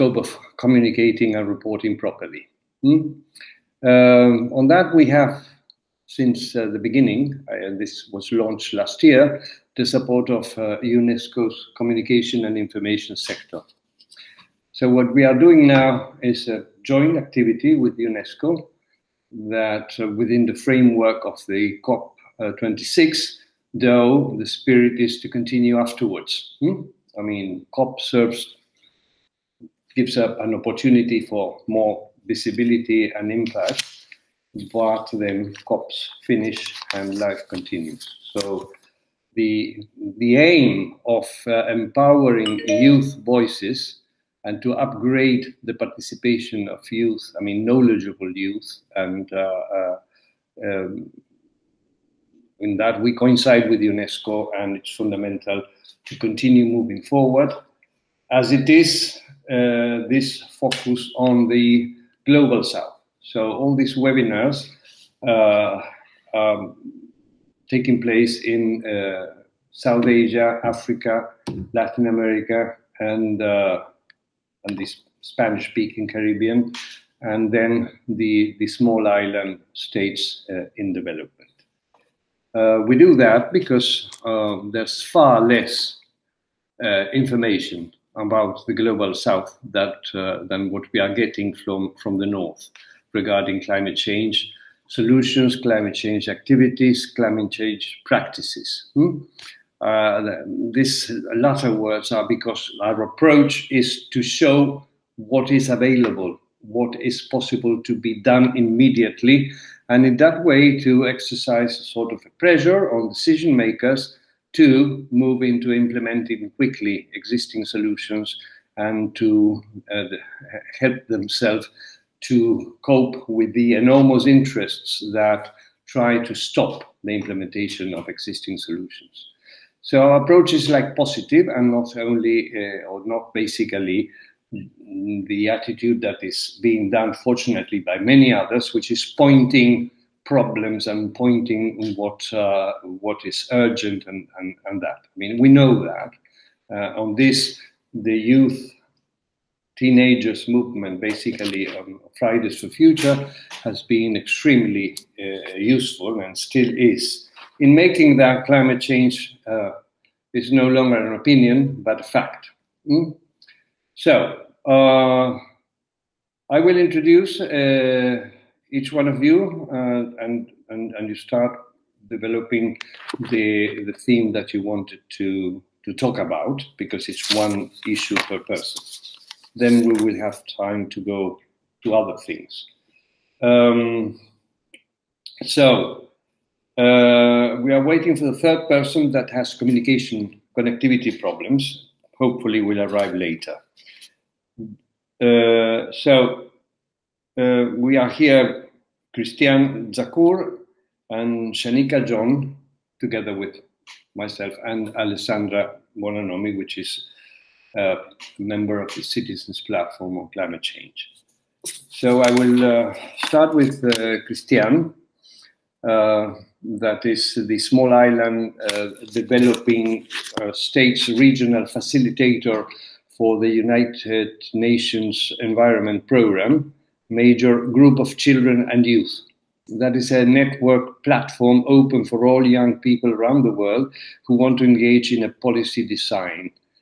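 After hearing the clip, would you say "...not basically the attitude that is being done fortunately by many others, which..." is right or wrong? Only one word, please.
right.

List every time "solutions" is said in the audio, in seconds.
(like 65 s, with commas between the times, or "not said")
94 s, 117 s, 128 s.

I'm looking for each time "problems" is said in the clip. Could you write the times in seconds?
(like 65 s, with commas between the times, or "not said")
140 s, 191 s.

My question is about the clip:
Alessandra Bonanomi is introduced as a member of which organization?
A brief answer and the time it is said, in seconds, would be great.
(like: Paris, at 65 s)
Citizens Platform on Climate Change, at 209 s.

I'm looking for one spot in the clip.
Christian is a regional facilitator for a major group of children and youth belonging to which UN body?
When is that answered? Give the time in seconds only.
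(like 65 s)
223 s.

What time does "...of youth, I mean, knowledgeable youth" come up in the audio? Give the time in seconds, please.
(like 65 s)
46 s.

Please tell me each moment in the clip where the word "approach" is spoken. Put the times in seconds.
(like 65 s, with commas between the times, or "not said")
103 s, 130 s.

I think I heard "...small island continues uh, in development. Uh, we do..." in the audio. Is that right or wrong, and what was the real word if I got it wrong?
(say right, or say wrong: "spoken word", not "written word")
wrong: "states", not "continues".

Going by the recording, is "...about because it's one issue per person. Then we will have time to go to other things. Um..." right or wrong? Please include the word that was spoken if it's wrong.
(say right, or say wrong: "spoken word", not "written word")
right.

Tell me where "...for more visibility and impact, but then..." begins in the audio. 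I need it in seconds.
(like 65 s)
31 s.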